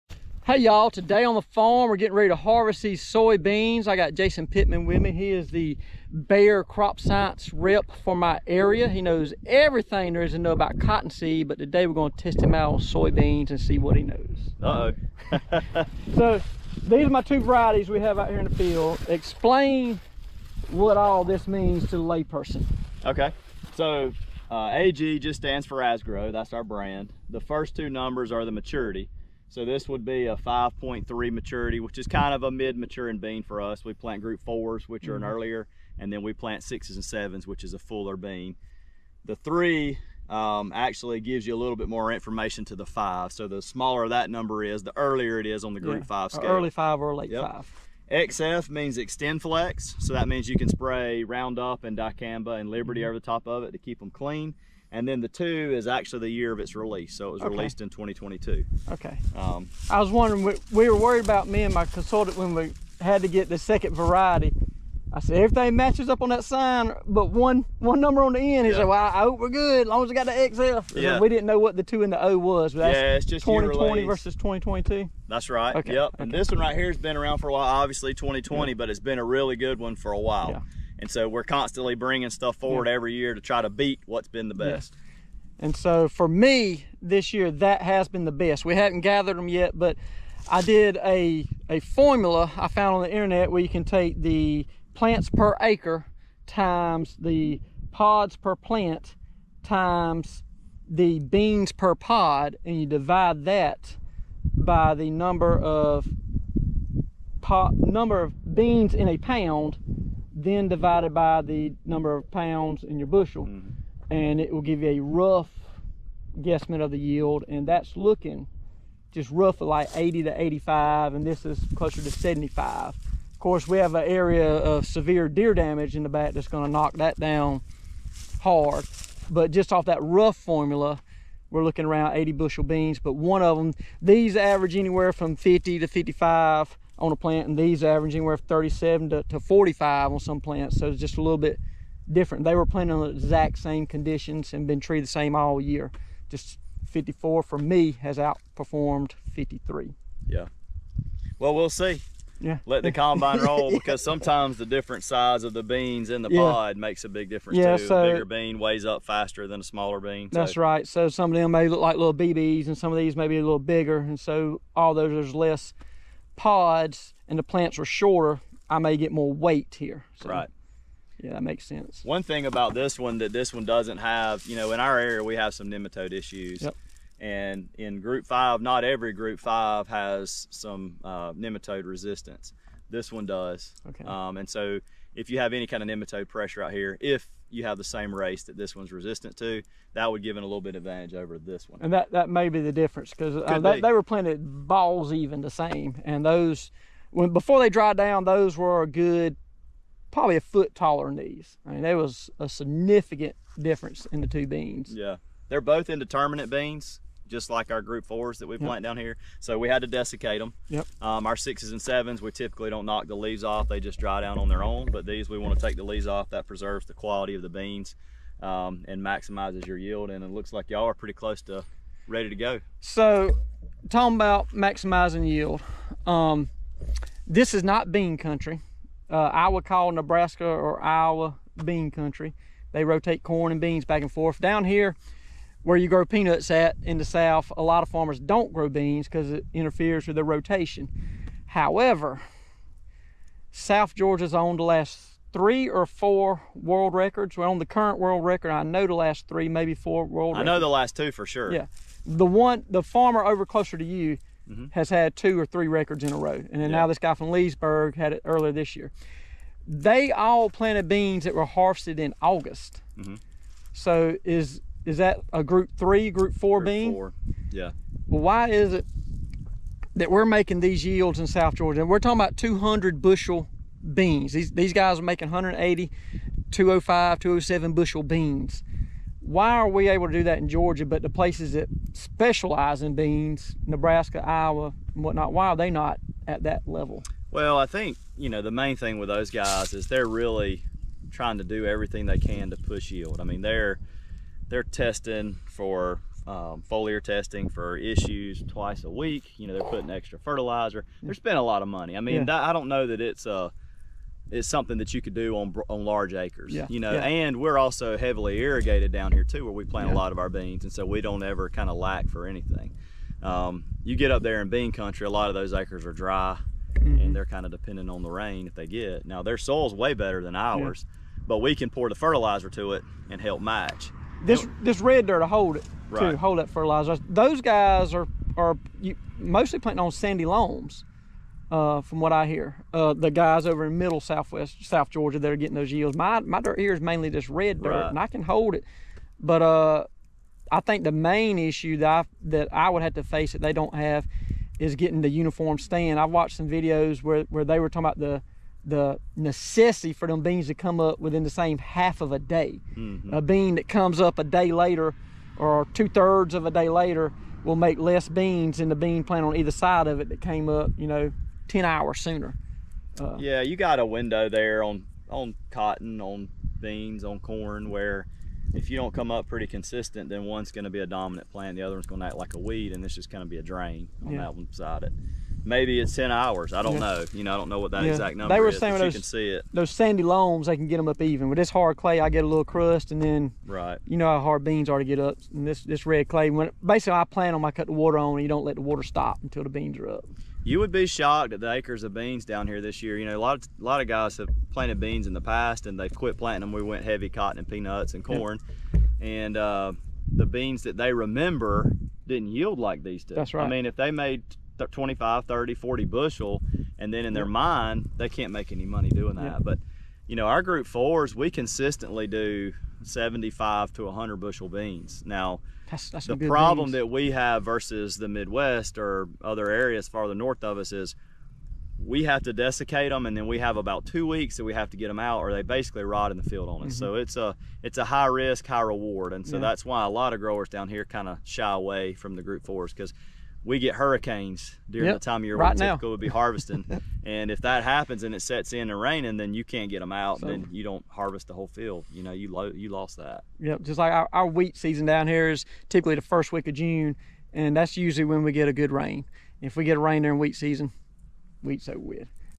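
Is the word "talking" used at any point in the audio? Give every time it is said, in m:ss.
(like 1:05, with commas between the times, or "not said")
3:43, 4:31, 5:47.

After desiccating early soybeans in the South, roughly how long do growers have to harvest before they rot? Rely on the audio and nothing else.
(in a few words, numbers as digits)
2 weeks.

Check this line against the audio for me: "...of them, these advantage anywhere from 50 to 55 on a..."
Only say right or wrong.
wrong.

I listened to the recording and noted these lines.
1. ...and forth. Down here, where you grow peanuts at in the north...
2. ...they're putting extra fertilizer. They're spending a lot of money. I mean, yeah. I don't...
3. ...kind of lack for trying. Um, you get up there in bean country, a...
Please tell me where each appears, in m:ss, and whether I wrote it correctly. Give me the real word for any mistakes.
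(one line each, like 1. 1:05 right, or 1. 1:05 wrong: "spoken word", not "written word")
1. 3:54 wrong: "south", not "north"
2. 4:59 right
3. 5:11 wrong: "anything", not "trying".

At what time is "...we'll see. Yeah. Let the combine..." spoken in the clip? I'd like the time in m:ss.
2:31.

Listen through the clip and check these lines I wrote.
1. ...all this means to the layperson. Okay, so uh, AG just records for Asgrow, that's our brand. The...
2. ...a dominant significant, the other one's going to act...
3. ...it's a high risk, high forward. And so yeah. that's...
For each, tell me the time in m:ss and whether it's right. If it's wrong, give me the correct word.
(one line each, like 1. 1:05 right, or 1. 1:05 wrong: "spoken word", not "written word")
1. 0:20 wrong: "stands", not "records"
2. 6:10 wrong: "plant", not "significant"
3. 7:07 wrong: "reward", not "forward".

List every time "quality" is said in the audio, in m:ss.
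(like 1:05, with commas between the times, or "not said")
3:36.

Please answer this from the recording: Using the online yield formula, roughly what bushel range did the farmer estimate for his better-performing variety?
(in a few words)
80 to 85.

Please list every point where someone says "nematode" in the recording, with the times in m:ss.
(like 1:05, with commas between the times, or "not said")
2:55, 3:01, 3:05.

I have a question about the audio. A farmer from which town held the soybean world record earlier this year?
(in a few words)
Leesburg.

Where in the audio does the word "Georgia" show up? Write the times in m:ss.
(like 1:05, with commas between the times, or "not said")
4:03, 4:31, 4:40, 5:34.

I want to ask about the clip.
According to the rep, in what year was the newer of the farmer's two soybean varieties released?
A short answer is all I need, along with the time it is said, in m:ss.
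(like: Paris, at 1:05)
2022, at 0:57.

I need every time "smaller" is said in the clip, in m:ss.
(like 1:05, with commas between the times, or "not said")
0:43, 2:39.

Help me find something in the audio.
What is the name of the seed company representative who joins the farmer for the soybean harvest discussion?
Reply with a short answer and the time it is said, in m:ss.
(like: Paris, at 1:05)
Jason Pittman, at 0:04.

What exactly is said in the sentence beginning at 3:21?
I mean, there was a significant difference in the two beans.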